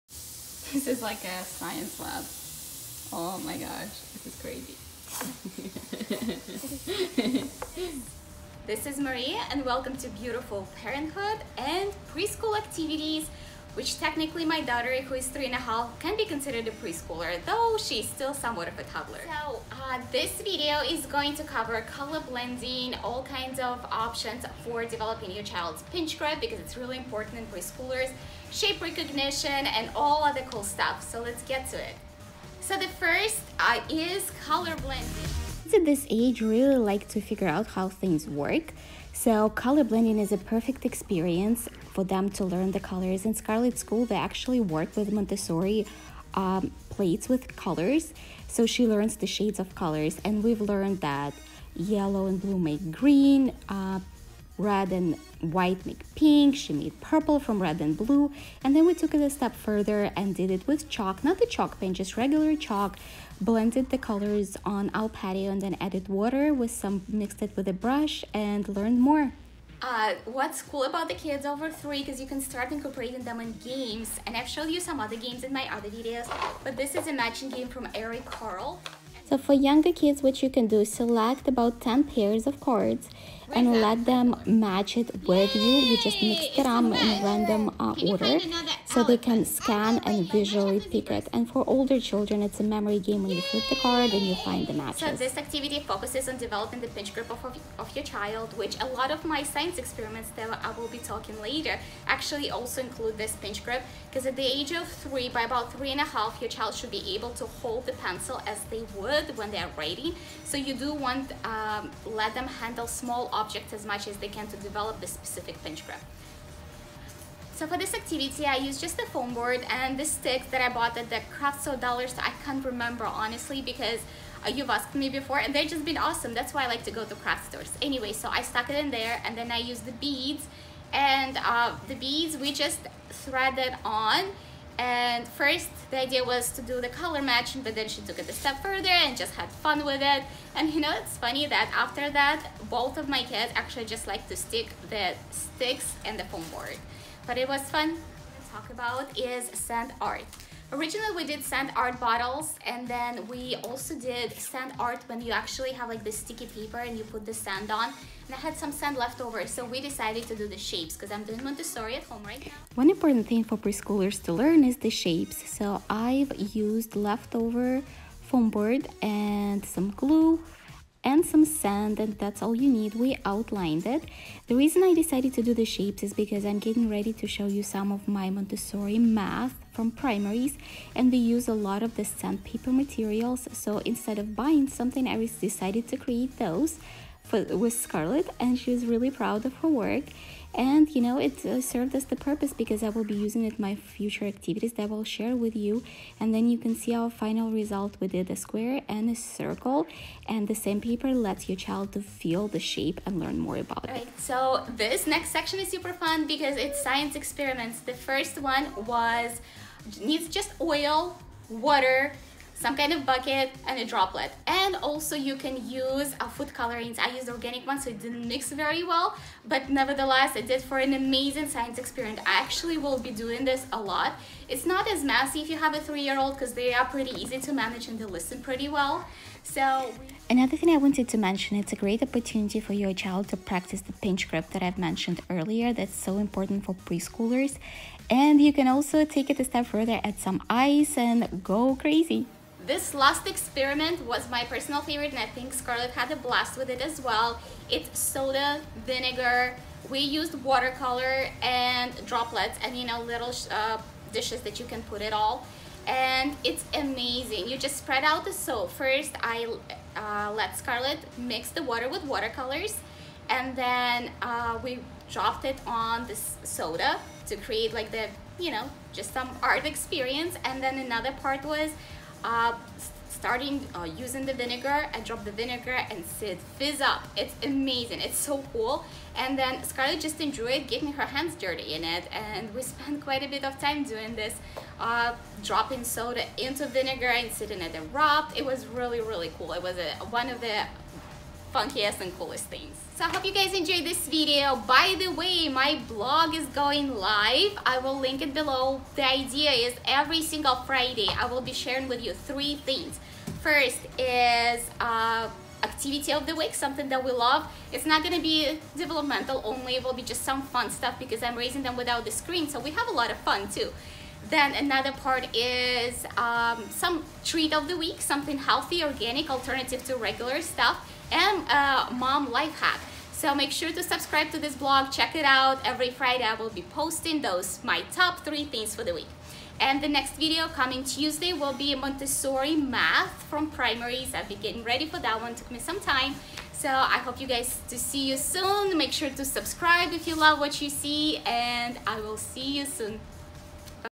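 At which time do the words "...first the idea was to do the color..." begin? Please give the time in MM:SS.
02:15.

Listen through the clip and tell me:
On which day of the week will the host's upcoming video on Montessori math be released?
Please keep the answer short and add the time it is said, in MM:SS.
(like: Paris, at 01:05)
Tuesday, at 05:30.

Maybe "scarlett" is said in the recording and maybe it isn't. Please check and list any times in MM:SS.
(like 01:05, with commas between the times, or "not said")
00:43, 03:07, 04:05, 04:20, 04:39.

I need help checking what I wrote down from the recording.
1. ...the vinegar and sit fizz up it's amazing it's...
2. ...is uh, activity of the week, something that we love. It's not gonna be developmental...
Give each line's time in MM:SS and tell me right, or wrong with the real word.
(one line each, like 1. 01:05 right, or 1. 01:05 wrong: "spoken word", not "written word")
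1. 04:35 right
2. 05:03 right.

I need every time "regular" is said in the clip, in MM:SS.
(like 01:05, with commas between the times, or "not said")
01:02, 05:19.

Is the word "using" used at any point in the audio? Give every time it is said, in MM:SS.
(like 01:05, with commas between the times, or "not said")
03:13, 04:33.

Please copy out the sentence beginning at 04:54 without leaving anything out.
By the way, my blog is going live.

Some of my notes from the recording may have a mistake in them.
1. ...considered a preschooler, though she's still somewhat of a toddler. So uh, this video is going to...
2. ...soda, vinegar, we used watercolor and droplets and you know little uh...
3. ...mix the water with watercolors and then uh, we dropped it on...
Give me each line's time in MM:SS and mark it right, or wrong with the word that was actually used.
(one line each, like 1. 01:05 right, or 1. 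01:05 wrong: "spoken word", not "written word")
1. 00:16 right
2. 04:07 right
3. 04:21 right.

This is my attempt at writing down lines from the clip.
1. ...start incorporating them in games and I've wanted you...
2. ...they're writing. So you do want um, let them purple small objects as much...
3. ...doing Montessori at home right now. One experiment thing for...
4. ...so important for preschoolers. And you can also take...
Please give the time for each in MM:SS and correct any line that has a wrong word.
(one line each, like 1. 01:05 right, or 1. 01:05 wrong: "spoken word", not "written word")
1. 01:12 wrong: "showed", not "wanted"
2. 01:49 wrong: "handle", not "purple"
3. 02:41 wrong: "important", not "experiment"
4. 03:55 right.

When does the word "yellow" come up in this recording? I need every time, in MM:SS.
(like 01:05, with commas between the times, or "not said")
00:51.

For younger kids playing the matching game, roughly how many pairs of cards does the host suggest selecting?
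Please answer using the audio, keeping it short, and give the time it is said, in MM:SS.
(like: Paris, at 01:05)
10, at 01:21.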